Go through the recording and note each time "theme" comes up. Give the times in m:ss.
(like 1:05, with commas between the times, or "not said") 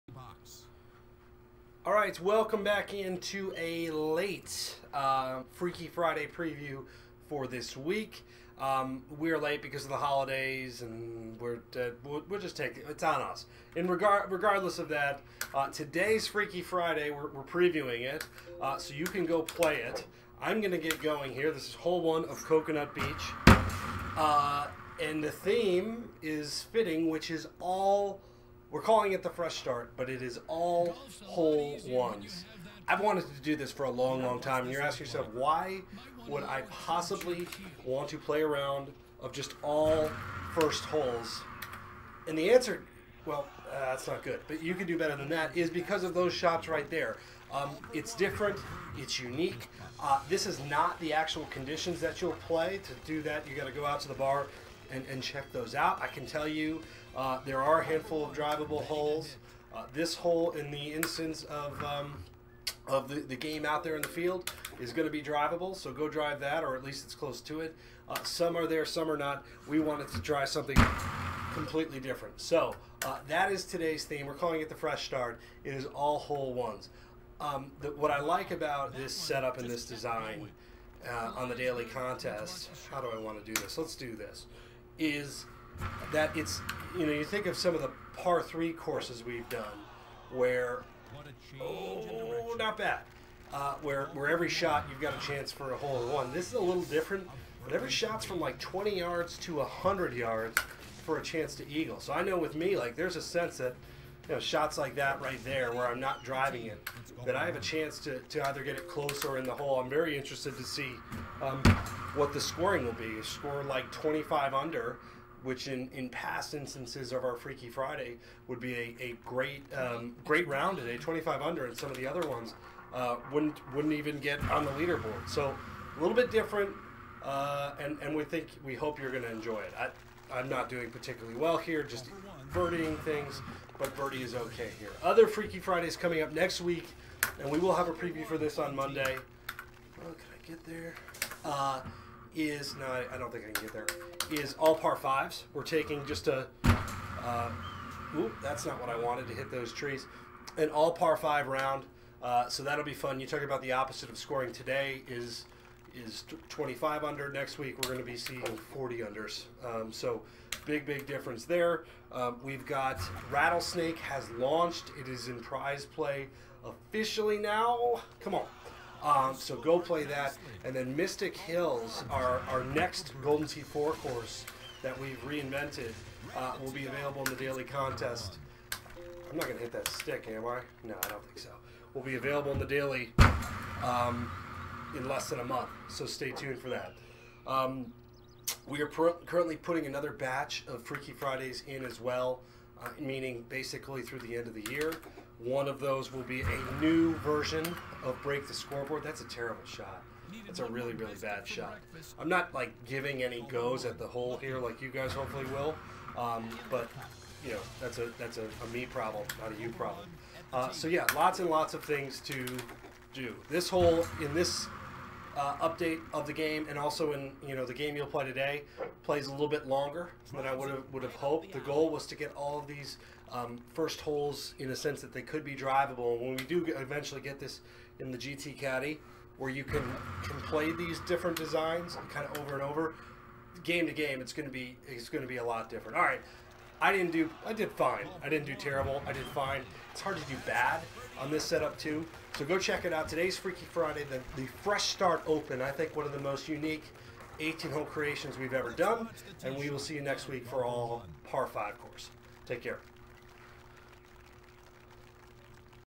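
0:25, 1:14.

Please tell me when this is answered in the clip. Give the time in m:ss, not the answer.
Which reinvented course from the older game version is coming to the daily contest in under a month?
2:50.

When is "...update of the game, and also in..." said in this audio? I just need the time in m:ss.
3:35.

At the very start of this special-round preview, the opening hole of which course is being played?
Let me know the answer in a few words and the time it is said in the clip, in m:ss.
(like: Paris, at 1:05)
Coconut Beach, at 0:22.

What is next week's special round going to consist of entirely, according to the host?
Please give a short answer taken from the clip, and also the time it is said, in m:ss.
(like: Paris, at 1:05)
All par fives, at 2:24.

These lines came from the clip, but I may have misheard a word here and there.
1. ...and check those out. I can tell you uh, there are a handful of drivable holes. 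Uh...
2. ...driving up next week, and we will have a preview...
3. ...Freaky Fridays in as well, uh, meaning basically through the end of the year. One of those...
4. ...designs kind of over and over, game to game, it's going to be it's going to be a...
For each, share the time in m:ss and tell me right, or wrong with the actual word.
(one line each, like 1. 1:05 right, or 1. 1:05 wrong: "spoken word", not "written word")
1. 0:55 right
2. 2:15 wrong: "coming", not "driving"
3. 3:10 right
4. 3:51 right.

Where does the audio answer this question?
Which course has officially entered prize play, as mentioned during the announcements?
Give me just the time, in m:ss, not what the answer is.
2:43.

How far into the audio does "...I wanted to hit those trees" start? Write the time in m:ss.
2:28.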